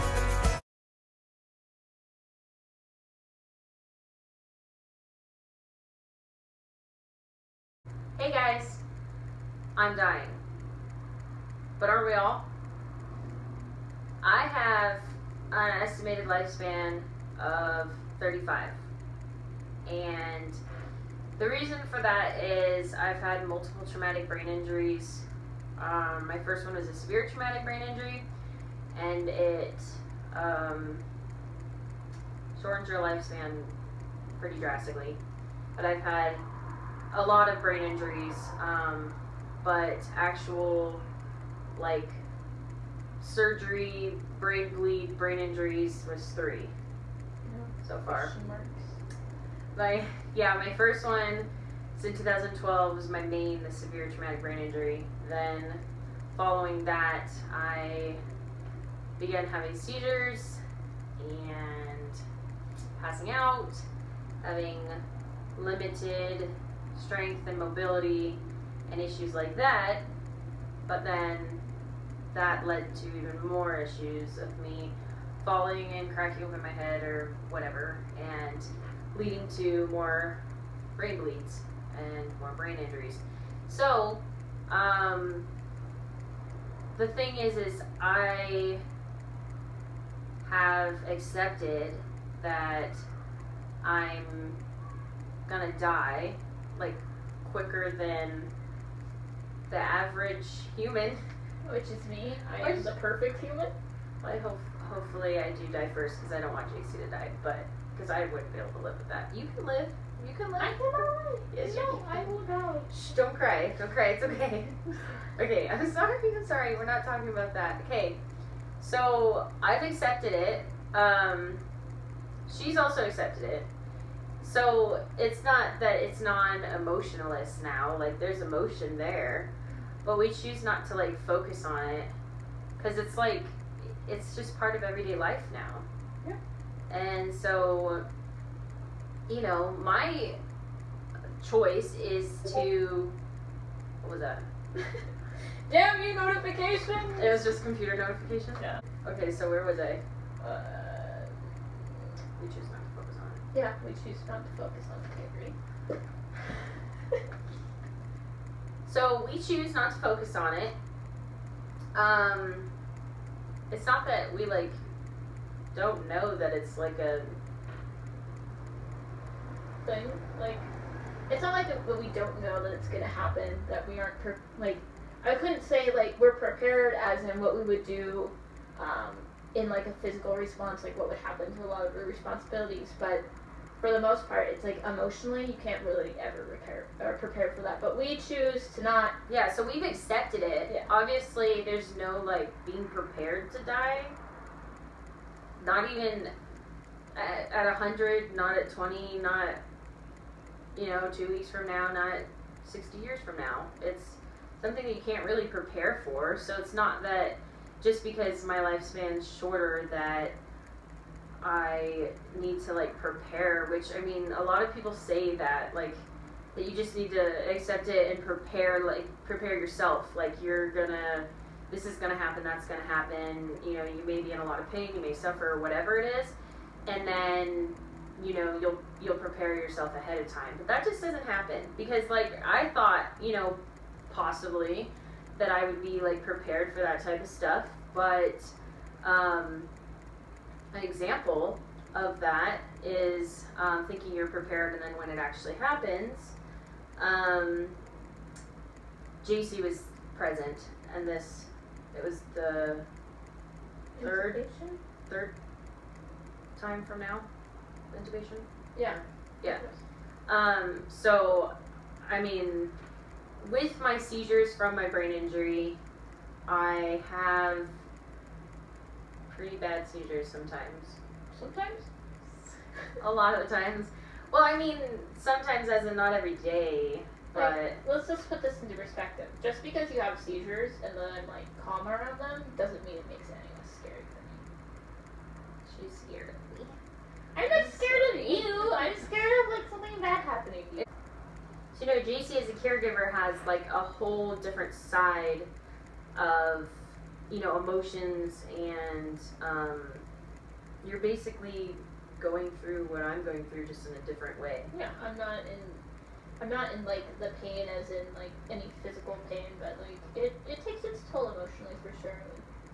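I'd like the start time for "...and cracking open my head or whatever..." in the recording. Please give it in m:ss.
1:15.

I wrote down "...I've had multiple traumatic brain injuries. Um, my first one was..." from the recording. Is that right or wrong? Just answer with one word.
right.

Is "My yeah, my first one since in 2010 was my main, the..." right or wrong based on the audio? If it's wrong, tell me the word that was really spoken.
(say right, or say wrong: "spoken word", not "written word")
wrong: "2012", not "2010".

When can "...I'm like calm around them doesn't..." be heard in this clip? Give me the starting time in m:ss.
4:41.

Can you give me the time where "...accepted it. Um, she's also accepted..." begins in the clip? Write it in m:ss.
1:59.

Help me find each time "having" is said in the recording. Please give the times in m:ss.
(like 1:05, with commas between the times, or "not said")
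0:59, 1:04.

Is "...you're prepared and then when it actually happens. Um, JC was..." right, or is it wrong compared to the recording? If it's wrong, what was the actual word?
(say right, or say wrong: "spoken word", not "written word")
right.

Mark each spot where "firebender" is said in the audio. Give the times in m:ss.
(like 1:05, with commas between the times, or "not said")
not said.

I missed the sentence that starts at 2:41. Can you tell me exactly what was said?
Um, it's not that we like don't know that it's like a thing.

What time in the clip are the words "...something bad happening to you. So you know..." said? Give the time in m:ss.
4:49.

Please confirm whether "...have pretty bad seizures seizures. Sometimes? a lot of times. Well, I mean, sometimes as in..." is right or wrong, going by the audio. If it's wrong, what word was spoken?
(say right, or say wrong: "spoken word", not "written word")
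wrong: "sometimes", not "seizures".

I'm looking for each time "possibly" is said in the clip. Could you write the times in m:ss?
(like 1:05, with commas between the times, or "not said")
3:54.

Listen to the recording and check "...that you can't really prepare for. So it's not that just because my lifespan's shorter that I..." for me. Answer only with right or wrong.
right.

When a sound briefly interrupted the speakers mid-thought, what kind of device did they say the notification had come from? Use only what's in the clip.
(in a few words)
computer.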